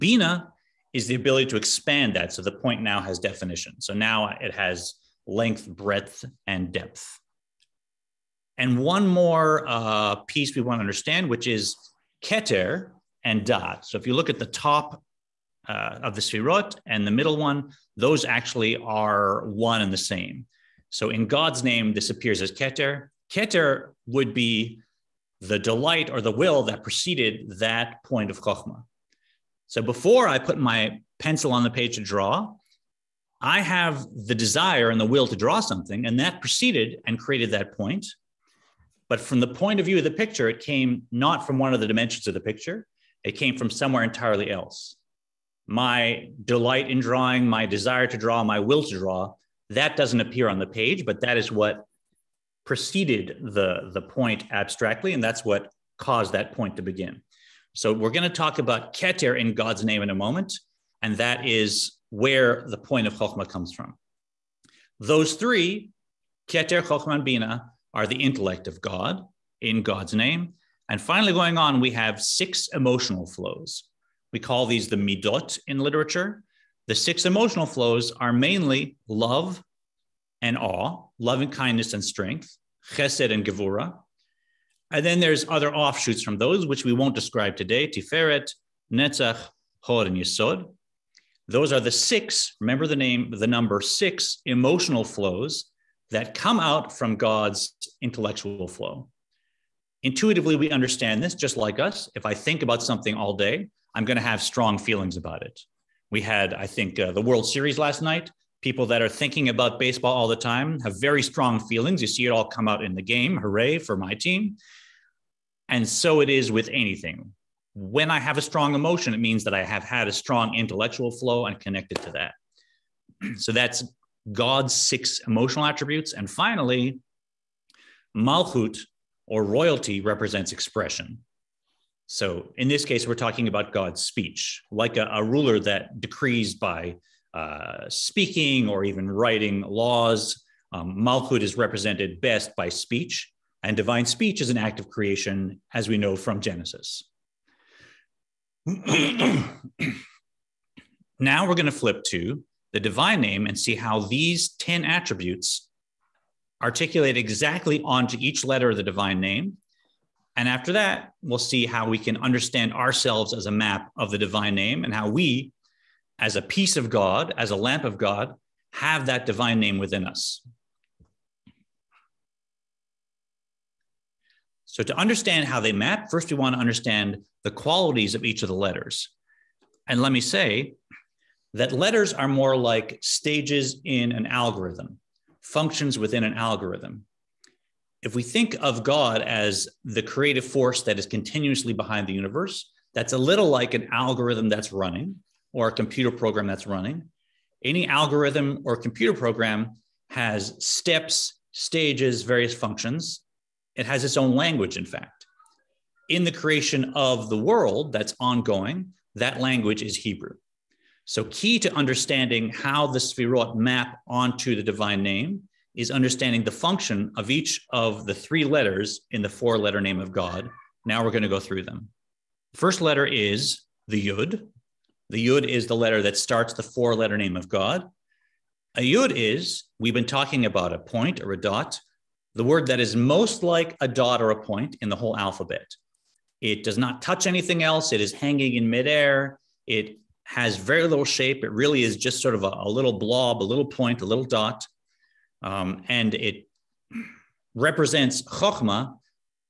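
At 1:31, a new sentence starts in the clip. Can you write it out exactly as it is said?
Those are the six, remember the name, the number six emotional flows that come out from God's intellectual flow.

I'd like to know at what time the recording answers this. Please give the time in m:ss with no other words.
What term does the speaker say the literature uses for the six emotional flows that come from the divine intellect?
1:14.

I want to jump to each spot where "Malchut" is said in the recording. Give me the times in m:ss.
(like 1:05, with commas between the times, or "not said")
2:08, 2:20.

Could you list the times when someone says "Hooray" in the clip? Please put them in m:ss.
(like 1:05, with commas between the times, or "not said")
1:53.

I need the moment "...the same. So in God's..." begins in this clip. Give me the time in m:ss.
0:19.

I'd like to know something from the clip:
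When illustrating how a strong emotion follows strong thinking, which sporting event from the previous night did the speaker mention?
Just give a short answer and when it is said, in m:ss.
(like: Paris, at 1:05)
World Series, at 1:47.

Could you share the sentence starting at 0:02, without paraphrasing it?
So the point now has definition.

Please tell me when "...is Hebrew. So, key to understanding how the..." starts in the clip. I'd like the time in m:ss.
3:29.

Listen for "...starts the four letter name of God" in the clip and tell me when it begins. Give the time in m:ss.
3:46.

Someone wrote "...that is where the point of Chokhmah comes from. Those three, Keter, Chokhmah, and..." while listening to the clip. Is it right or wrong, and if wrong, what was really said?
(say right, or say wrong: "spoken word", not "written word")
right.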